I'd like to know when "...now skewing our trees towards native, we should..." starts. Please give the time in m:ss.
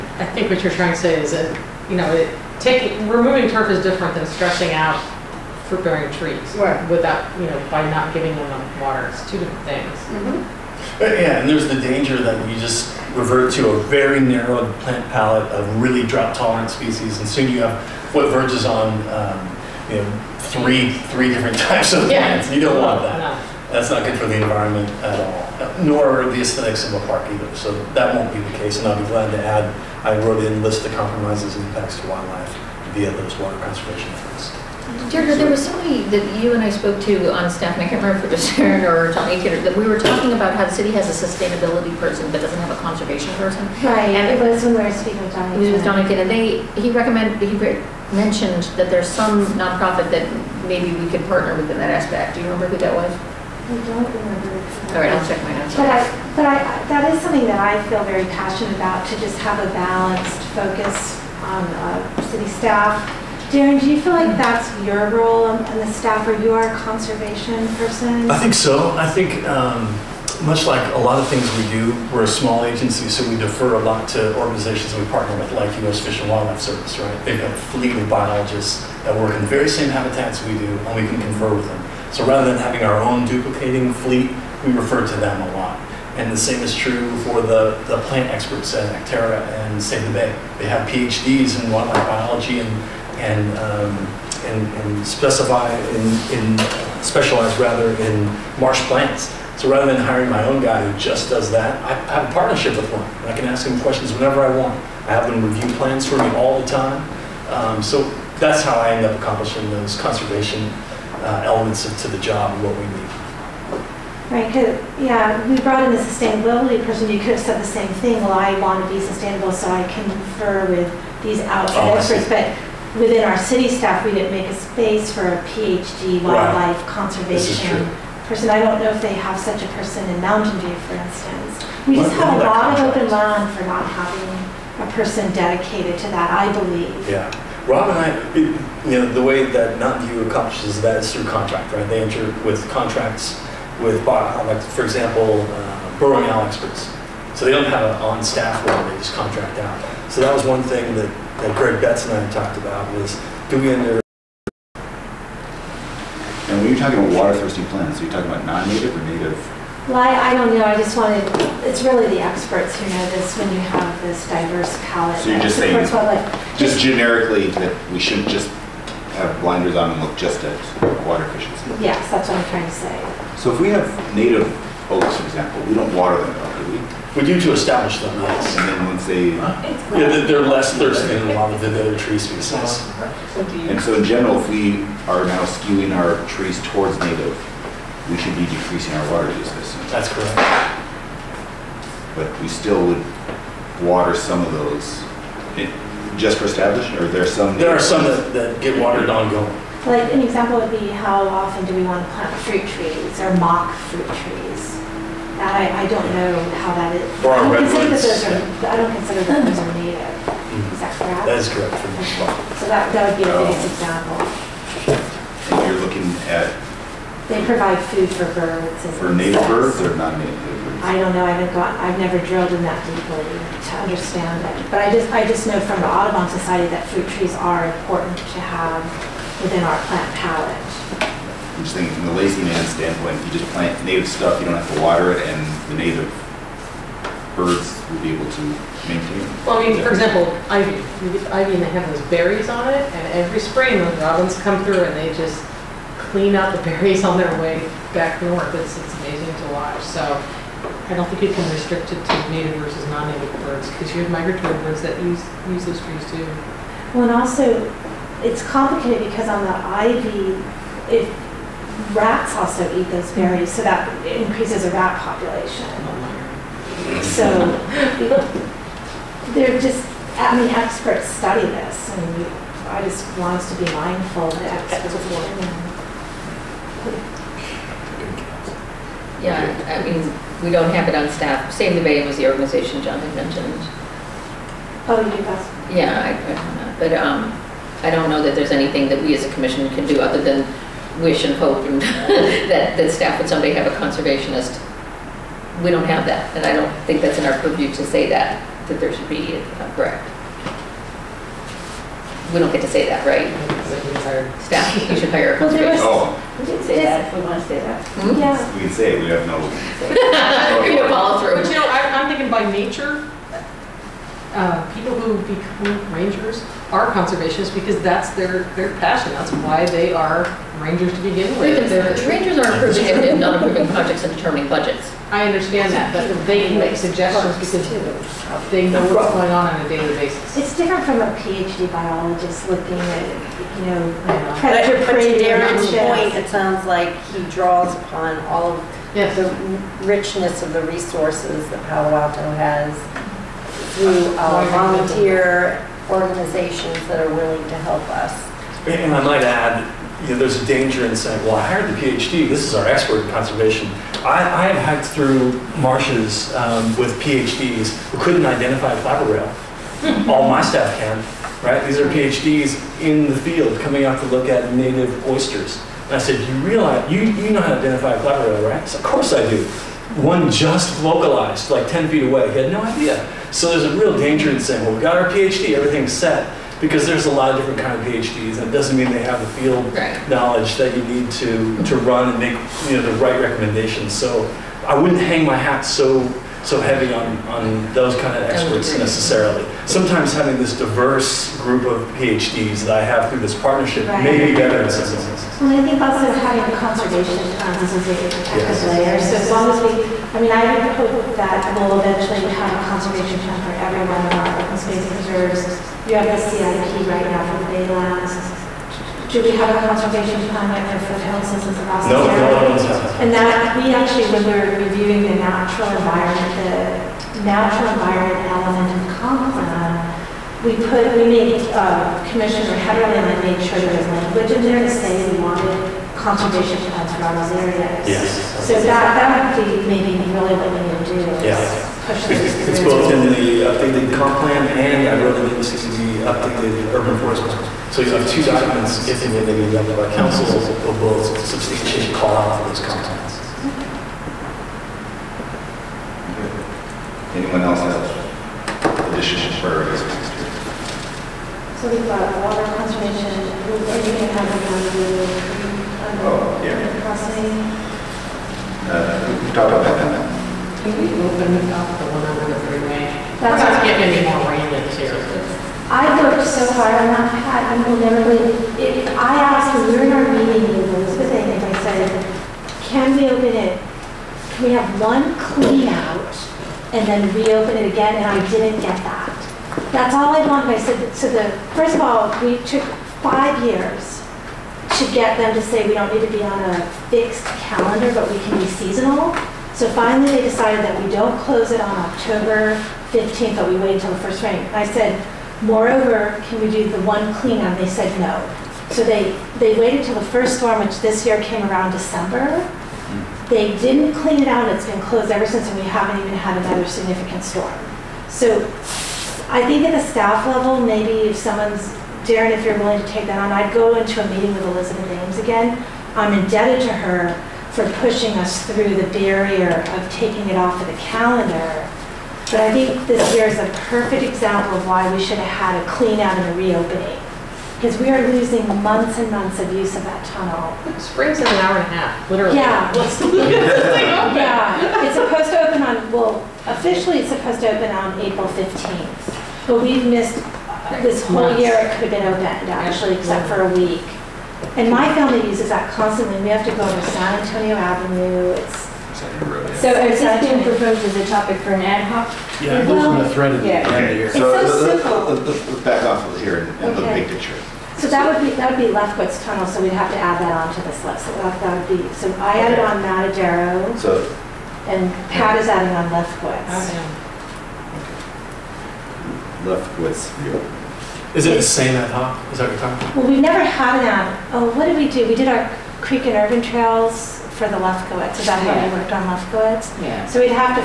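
3:05.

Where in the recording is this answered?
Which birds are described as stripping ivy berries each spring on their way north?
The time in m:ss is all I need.
4:03.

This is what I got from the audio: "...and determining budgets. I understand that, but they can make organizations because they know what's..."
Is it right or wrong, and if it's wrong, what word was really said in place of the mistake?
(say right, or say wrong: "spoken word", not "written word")
wrong: "suggestions", not "organizations".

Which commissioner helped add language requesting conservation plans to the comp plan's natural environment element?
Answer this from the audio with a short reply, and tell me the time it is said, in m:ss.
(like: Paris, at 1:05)
Commissioner Hetterly, at 7:02.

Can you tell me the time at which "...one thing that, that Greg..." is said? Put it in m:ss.
2:30.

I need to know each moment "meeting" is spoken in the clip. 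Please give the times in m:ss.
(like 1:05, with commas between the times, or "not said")
7:50, 8:34.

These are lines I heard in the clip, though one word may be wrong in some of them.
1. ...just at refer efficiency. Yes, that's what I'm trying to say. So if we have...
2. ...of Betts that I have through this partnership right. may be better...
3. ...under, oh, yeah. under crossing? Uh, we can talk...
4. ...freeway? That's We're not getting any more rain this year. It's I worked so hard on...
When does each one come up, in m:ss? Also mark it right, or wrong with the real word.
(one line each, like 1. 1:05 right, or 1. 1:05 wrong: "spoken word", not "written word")
1. 2:50 wrong: "water", not "refer"
2. 6:31 wrong: "PhDs", not "Betts"
3. 7:35 right
4. 7:42 right.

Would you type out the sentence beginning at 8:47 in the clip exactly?
Because we are losing months and months of use of that tunnel.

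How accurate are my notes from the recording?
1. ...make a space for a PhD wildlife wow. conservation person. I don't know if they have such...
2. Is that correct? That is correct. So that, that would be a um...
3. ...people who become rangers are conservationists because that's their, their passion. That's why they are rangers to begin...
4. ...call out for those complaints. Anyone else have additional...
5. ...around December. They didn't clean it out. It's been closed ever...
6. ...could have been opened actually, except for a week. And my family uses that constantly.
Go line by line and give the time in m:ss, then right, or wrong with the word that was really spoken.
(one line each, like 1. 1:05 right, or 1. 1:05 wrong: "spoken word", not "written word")
1. 2:04 right
2. 3:30 right
3. 5:14 right
4. 7:21 right
5. 8:21 right
6. 9:01 right.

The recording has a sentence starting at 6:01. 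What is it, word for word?
These are PhDs in the field coming out to look at native oysters.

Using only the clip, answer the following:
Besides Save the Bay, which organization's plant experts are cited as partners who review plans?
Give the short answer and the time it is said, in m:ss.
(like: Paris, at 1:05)
Acterra, at 1:28.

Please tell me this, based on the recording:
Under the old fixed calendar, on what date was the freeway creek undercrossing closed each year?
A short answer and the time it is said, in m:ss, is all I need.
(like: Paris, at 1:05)
October 15, at 8:11.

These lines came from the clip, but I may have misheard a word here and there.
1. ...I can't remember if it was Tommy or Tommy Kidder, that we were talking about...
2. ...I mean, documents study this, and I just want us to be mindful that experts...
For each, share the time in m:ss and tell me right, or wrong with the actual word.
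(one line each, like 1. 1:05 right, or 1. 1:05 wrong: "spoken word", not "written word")
1. 0:37 wrong: "Sharon", not "Tommy"
2. 4:30 wrong: "experts", not "documents".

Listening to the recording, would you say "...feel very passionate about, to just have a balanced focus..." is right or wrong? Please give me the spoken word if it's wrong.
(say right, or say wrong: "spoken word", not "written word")
right.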